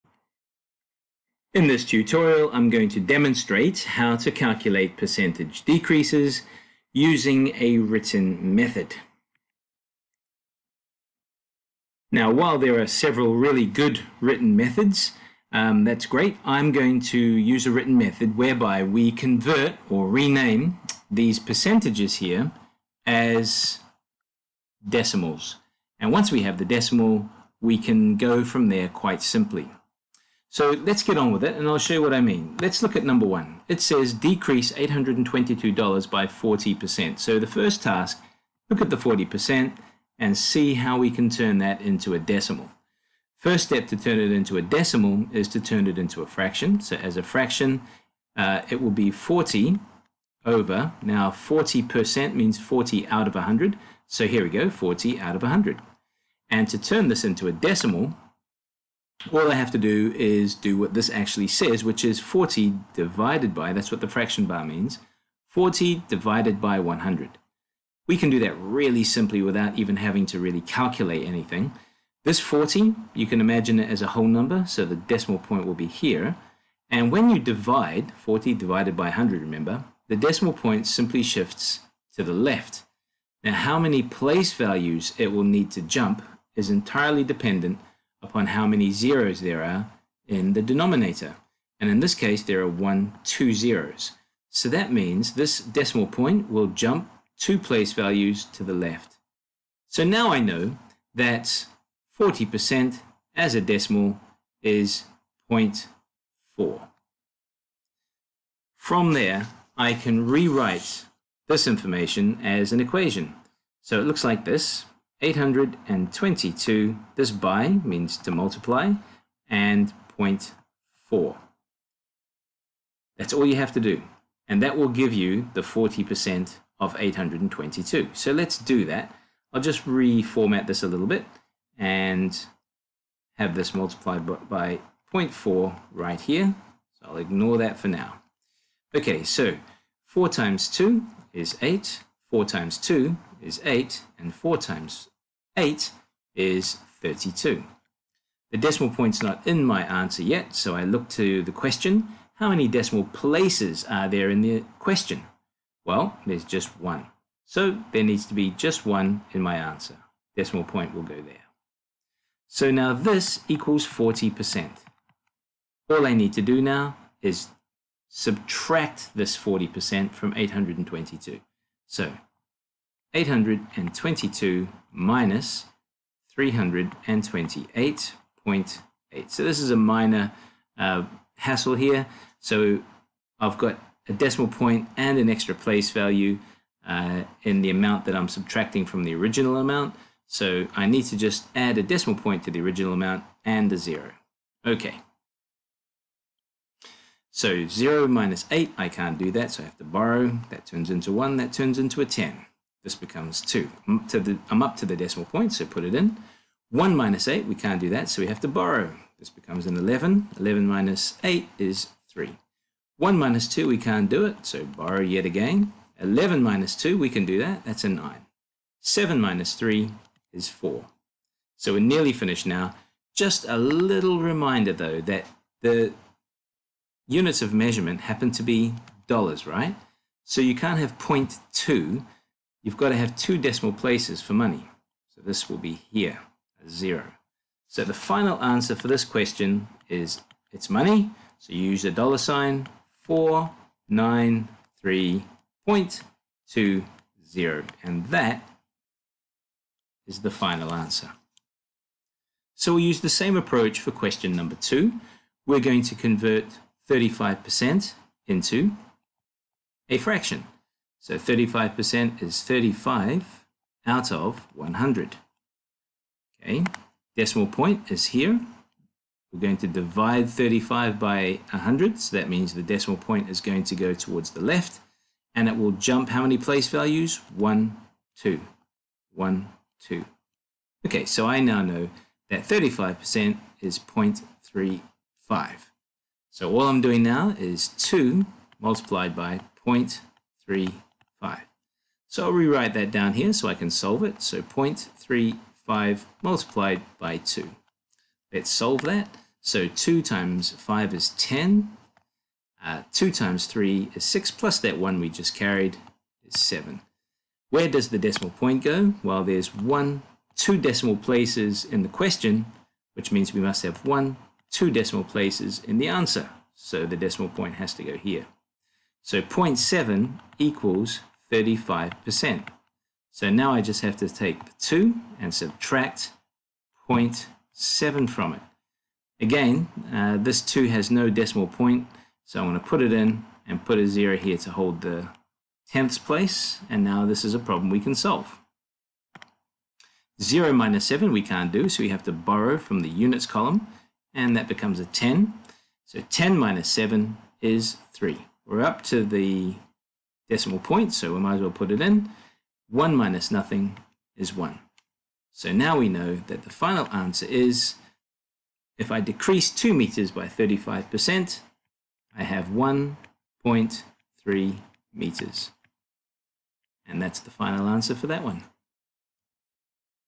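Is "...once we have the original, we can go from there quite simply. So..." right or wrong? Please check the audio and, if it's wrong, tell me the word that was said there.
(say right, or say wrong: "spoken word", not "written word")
wrong: "decimal", not "original".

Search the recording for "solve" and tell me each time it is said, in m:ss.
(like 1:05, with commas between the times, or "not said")
4:53, 4:58, 5:37.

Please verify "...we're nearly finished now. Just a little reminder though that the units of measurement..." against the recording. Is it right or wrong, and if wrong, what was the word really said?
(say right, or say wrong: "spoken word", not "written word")
right.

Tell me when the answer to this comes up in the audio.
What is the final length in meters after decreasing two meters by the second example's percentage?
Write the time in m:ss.
6:02.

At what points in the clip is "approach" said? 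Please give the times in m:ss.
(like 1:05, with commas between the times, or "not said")
4:13.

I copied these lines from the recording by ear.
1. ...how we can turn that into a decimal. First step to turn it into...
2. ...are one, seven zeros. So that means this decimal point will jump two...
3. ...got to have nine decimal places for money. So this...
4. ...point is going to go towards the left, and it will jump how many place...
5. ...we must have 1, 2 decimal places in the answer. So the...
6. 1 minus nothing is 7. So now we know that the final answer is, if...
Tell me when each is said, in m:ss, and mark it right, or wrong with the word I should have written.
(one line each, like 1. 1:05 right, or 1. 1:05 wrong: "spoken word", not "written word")
1. 0:40 right
2. 1:32 wrong: "two", not "seven"
3. 3:52 wrong: "two", not "nine"
4. 4:32 right
5. 5:13 right
6. 5:52 wrong: "1", not "7".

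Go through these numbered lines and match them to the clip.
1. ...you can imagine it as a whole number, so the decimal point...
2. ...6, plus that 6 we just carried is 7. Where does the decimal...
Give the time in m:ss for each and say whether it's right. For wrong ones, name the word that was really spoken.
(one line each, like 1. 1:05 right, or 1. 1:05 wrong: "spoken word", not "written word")
1. 1:13 right
2. 5:04 wrong: "1", not "6".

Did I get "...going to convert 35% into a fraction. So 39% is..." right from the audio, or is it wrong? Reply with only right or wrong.
wrong.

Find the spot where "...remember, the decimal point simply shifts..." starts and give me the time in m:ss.
1:19.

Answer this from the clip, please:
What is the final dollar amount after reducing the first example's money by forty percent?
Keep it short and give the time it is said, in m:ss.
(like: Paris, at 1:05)
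$493.20, at 4:03.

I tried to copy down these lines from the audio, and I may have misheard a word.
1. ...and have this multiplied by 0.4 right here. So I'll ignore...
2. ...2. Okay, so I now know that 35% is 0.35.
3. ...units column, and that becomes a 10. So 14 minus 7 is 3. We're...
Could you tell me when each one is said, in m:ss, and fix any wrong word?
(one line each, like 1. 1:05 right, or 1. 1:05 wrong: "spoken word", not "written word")
1. 2:11 right
2. 4:39 right
3. 5:42 wrong: "10", not "14".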